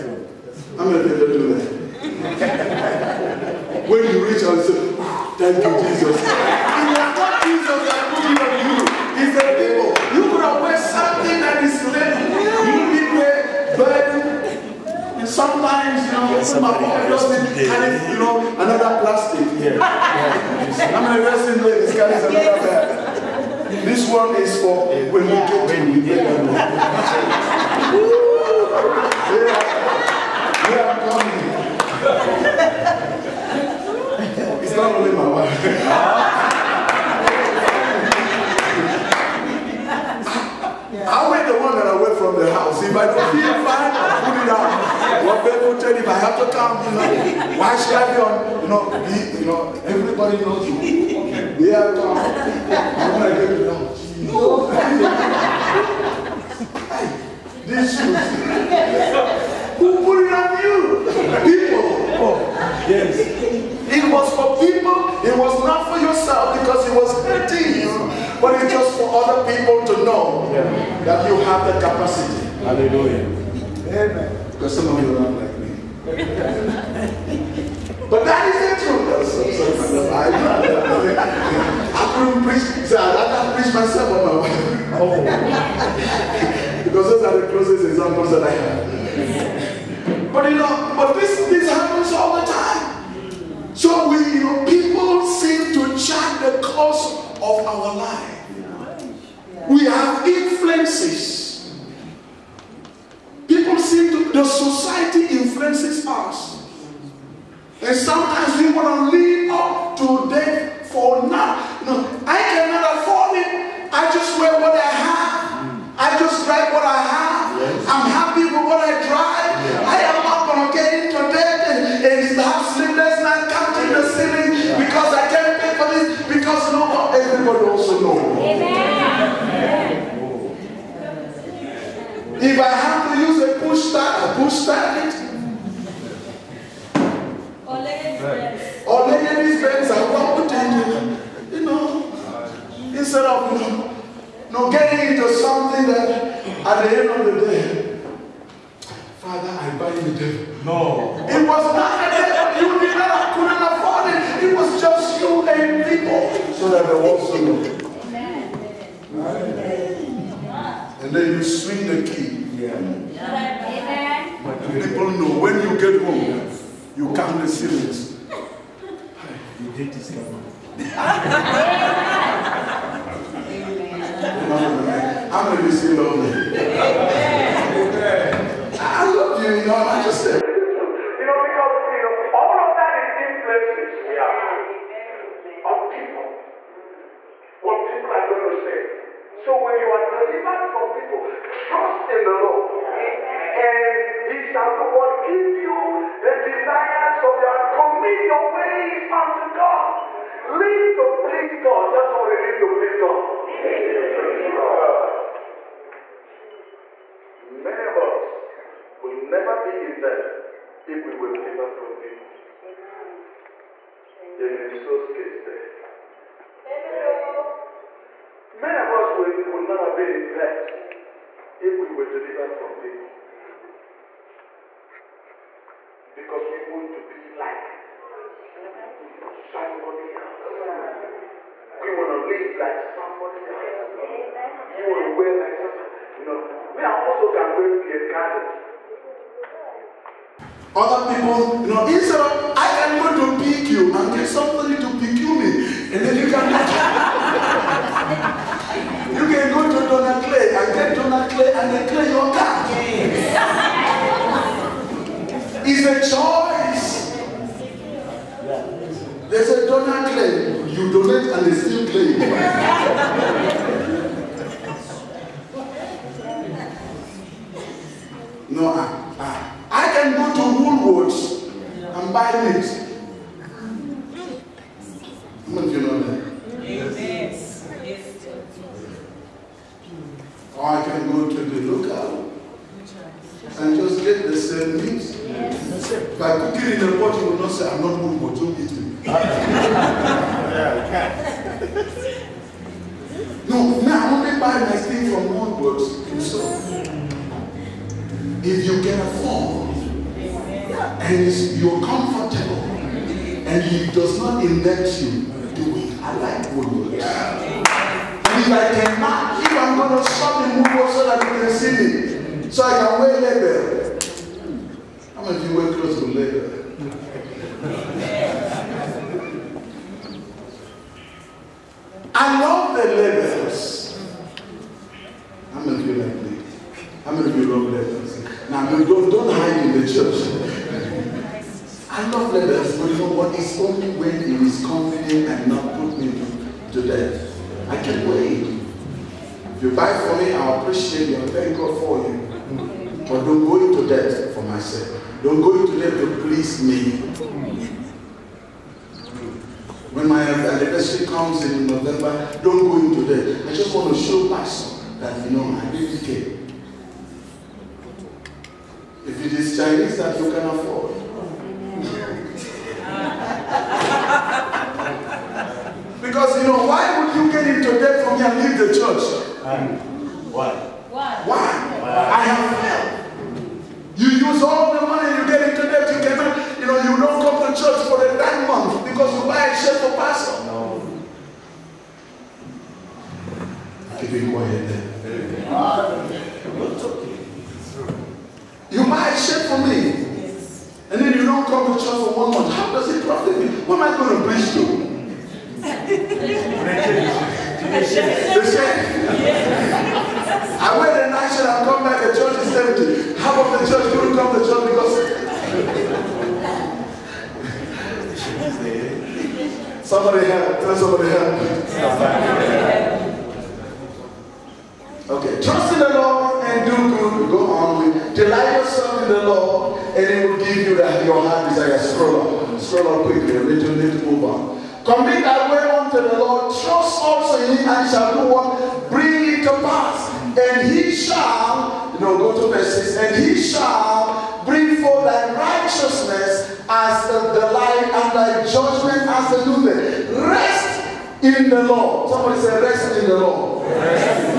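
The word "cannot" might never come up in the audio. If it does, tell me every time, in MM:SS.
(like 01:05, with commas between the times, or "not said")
01:52, 06:16.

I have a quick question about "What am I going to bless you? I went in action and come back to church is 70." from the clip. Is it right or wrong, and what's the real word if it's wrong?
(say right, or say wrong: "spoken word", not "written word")
right.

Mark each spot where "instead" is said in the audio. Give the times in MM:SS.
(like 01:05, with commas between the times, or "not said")
02:22, 04:01.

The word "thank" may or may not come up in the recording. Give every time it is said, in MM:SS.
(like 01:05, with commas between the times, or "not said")
00:05, 05:41.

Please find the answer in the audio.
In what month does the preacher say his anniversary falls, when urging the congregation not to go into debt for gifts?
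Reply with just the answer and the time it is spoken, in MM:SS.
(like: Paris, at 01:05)
November, at 05:51.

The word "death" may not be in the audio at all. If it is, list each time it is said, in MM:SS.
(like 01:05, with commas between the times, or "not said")
01:50, 05:36.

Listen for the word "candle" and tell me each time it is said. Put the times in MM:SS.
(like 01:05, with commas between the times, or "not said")
not said.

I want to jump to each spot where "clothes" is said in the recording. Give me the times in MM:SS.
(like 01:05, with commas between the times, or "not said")
05:15.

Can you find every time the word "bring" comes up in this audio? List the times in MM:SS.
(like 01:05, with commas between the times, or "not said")
07:08, 07:14.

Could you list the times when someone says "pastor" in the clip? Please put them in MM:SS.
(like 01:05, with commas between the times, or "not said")
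05:54, 06:19.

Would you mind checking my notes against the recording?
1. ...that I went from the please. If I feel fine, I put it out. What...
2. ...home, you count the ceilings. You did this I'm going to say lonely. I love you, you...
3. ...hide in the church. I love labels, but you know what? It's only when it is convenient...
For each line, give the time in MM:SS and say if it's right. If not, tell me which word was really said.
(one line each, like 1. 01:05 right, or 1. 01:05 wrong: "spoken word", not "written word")
1. 00:41 wrong: "house", not "please"
2. 02:46 right
3. 05:29 right.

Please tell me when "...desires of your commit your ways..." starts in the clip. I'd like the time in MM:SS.
03:16.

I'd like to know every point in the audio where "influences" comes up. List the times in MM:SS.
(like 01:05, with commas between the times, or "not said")
01:40, 01:45, 03:03.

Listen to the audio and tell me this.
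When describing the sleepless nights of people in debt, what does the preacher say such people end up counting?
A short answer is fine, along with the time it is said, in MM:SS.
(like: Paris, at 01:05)
the ceiling, at 02:03.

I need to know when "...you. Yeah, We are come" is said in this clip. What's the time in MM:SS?
00:50.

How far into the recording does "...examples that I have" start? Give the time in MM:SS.
01:27.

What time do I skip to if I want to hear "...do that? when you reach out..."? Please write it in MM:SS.
00:01.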